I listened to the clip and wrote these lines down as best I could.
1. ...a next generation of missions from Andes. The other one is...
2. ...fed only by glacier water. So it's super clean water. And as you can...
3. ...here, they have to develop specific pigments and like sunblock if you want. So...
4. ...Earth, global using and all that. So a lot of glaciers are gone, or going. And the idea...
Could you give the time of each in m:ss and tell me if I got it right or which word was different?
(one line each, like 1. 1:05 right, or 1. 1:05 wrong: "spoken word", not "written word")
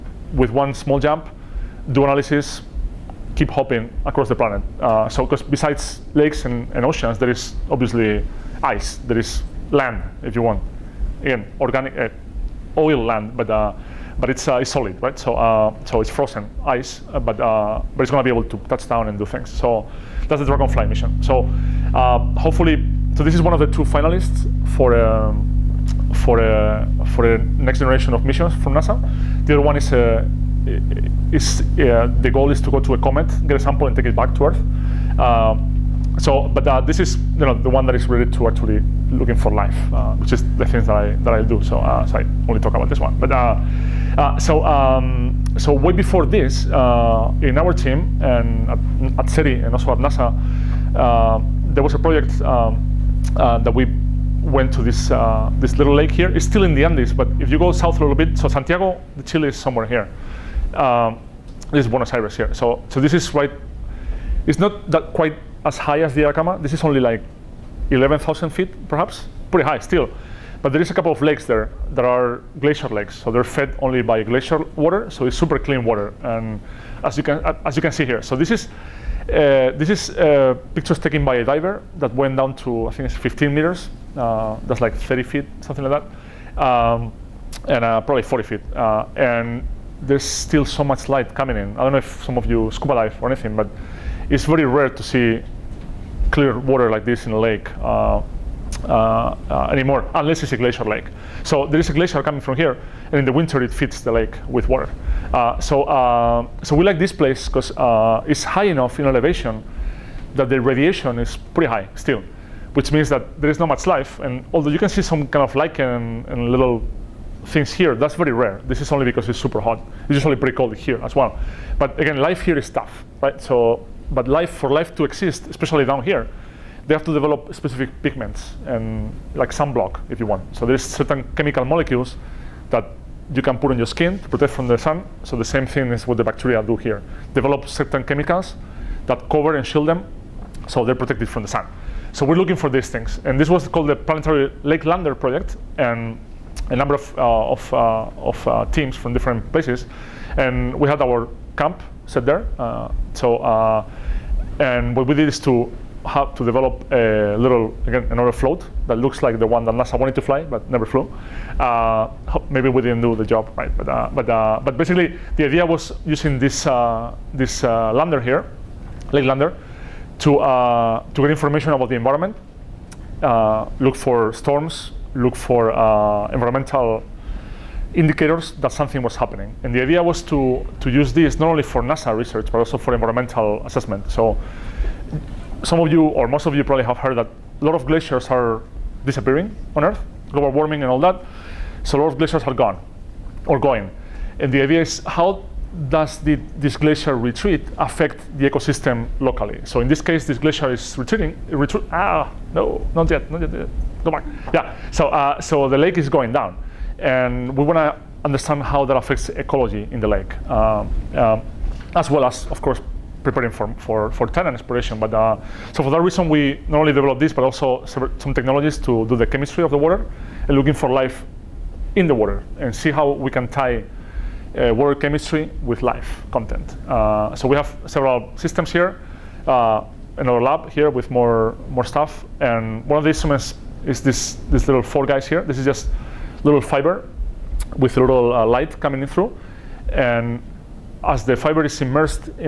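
1. 0:27 wrong: "NASA", not "Andes"
2. 1:13 right
3. 2:06 right
4. 3:09 wrong: "warming", not "using".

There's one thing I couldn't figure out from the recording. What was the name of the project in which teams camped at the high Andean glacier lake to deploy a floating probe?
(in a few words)
Planetary Lake Lander Project.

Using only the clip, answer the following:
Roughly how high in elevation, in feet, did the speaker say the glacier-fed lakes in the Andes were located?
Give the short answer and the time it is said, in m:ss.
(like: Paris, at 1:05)
11,000 feet, at 1:07.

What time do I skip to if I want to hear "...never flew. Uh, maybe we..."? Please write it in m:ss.
2:40.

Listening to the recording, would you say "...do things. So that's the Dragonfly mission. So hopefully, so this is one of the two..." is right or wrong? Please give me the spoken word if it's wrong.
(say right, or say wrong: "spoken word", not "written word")
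right.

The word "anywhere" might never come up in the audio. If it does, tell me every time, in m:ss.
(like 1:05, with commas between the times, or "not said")
not said.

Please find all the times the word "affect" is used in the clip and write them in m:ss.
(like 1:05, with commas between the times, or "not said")
3:17, 3:28.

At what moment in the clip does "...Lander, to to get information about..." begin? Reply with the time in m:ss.
2:49.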